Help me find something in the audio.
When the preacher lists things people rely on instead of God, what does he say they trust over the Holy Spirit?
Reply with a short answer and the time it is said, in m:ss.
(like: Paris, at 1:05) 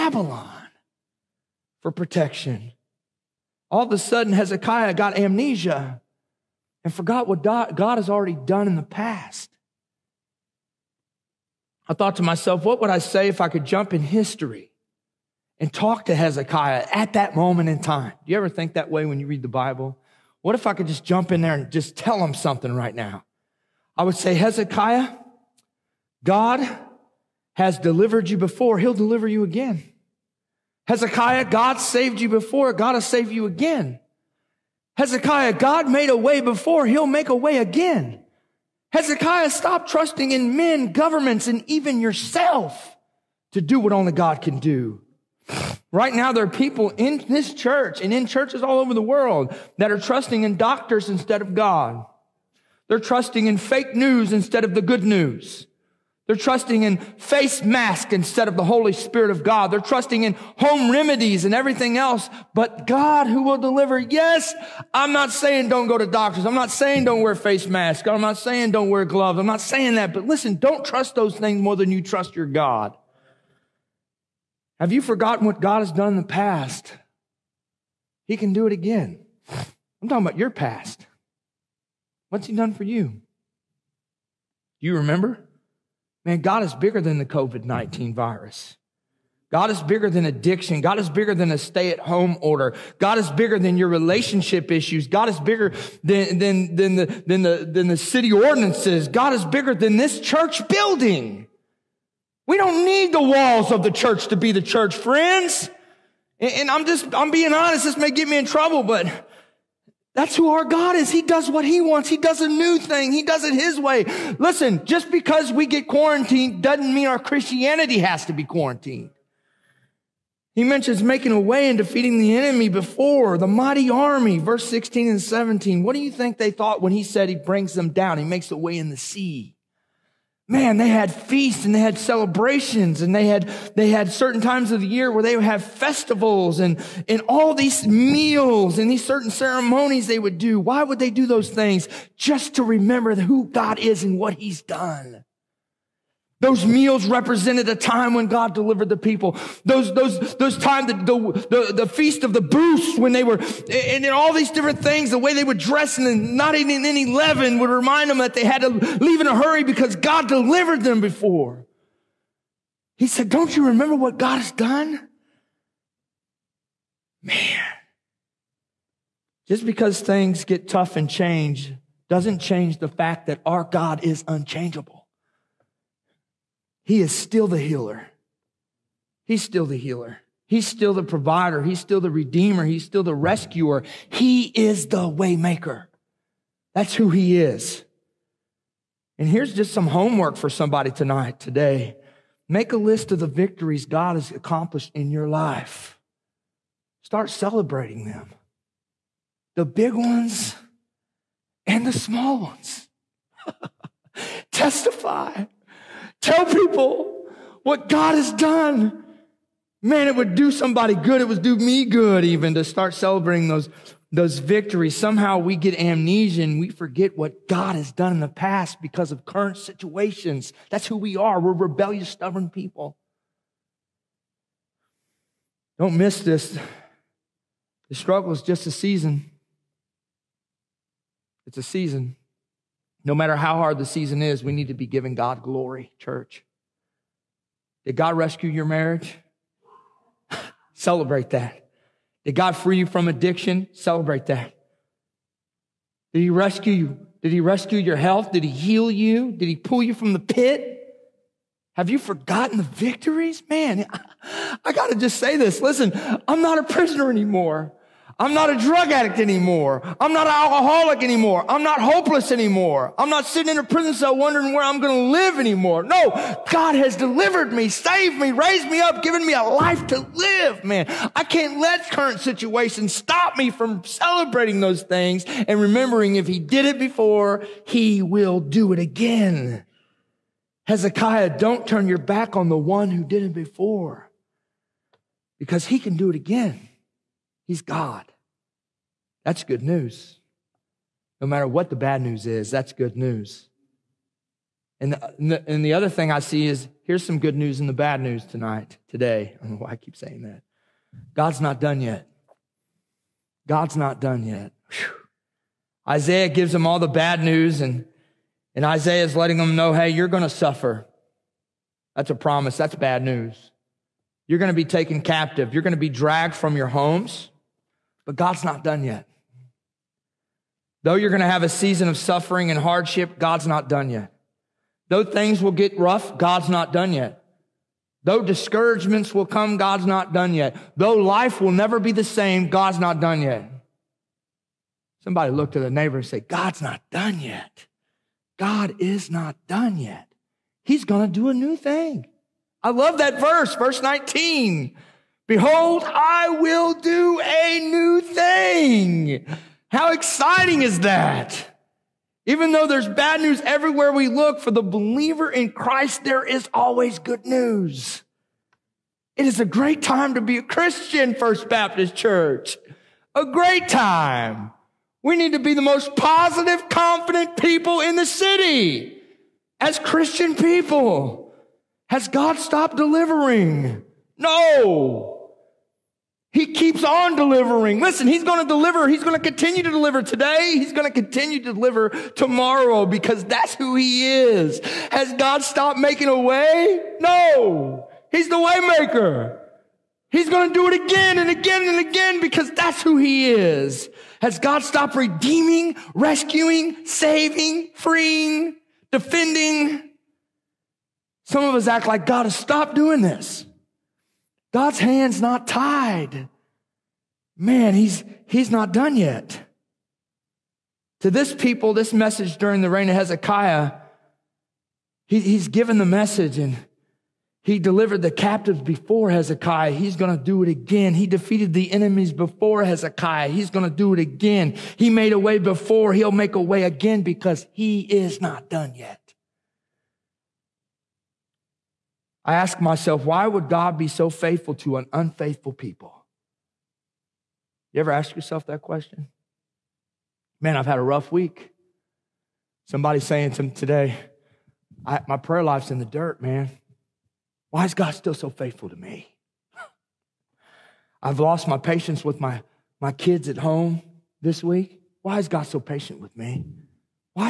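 face mask, at 0:56.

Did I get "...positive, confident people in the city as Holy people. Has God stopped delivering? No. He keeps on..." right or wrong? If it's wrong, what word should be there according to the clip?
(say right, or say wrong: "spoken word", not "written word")
wrong: "Christian", not "Holy".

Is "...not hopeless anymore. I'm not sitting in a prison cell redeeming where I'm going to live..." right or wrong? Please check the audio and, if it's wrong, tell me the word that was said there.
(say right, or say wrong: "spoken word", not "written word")
wrong: "wondering", not "redeeming".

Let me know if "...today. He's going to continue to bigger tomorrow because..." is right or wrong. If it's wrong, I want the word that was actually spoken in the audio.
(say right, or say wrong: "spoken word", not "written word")
wrong: "deliver", not "bigger".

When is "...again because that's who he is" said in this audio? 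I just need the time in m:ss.
6:31.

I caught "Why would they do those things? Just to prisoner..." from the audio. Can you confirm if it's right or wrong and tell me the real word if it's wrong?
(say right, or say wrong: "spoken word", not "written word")
wrong: "remember", not "prisoner".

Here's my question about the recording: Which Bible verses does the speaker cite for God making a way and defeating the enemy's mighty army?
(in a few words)
verses 16 and 17.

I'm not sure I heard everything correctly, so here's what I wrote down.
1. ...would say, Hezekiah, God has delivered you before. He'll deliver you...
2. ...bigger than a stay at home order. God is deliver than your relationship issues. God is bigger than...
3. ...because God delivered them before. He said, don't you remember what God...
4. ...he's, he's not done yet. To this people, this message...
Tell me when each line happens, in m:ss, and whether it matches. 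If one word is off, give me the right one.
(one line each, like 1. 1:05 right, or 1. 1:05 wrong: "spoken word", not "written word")
1. 0:24 right
2. 1:31 wrong: "bigger", not "deliver"
3. 2:39 right
4. 6:47 right.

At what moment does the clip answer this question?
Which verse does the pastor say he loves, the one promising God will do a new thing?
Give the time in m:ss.
5:43.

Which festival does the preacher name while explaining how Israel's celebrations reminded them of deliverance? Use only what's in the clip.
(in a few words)
feast of the booths.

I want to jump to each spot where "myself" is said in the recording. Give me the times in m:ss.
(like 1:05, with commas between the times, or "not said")
0:12, 7:12.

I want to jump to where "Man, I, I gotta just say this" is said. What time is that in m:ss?
4:13.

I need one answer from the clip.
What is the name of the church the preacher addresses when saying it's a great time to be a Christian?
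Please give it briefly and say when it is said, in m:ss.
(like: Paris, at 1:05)
First Baptist Church, at 6:01.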